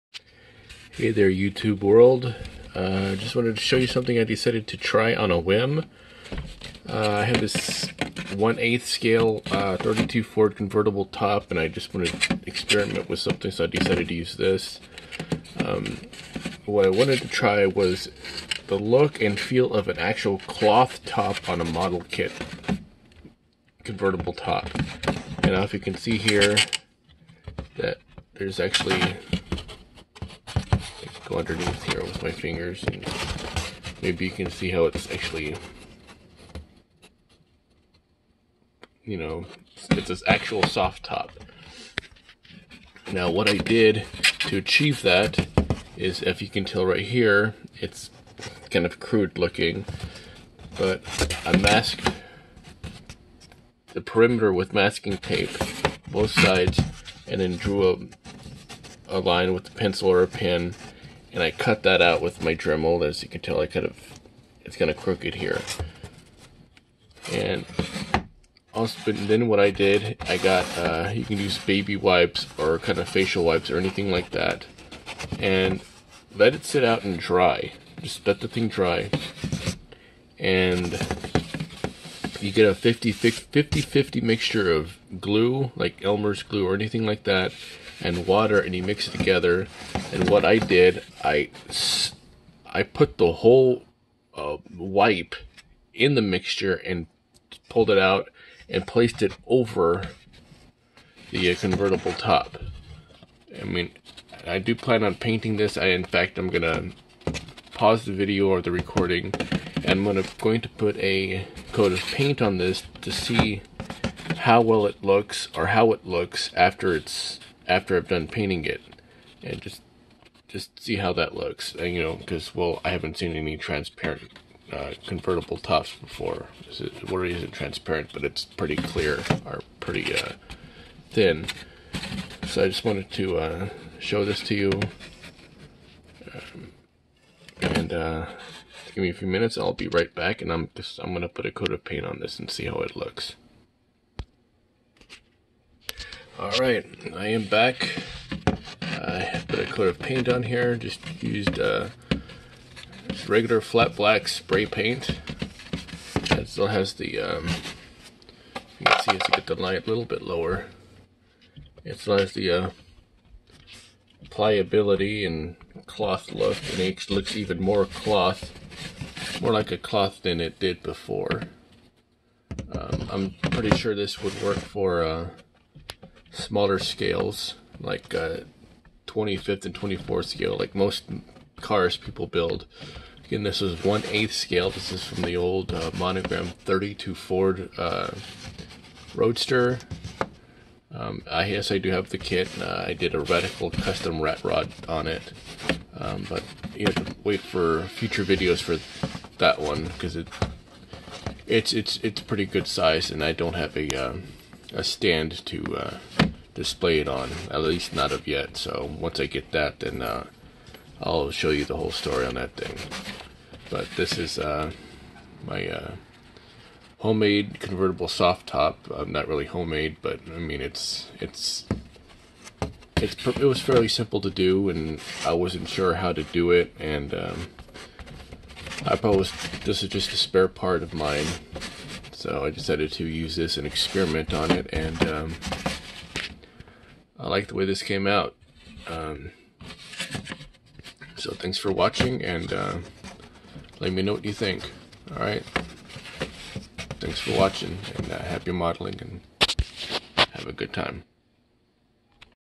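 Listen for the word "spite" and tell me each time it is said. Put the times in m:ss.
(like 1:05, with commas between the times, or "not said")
not said.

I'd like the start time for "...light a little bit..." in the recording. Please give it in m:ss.
2:39.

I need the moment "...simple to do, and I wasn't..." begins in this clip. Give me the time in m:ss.
3:43.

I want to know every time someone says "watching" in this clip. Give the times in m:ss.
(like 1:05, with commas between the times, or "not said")
4:01, 4:07.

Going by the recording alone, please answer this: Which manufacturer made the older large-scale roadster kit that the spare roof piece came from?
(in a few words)
Monogram.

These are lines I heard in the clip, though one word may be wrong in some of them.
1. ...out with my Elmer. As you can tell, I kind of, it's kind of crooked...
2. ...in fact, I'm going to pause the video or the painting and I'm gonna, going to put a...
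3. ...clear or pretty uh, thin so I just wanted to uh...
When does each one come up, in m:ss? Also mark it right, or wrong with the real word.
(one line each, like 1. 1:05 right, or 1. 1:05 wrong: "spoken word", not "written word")
1. 1:02 wrong: "Dremel", not "Elmer"
2. 1:45 wrong: "recording", not "painting"
3. 2:08 right.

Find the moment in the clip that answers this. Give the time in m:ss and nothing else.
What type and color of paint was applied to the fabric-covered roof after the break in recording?
2:33.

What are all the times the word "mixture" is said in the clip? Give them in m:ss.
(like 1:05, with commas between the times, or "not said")
1:24, 1:36.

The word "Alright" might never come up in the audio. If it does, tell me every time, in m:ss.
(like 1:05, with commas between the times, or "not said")
4:05.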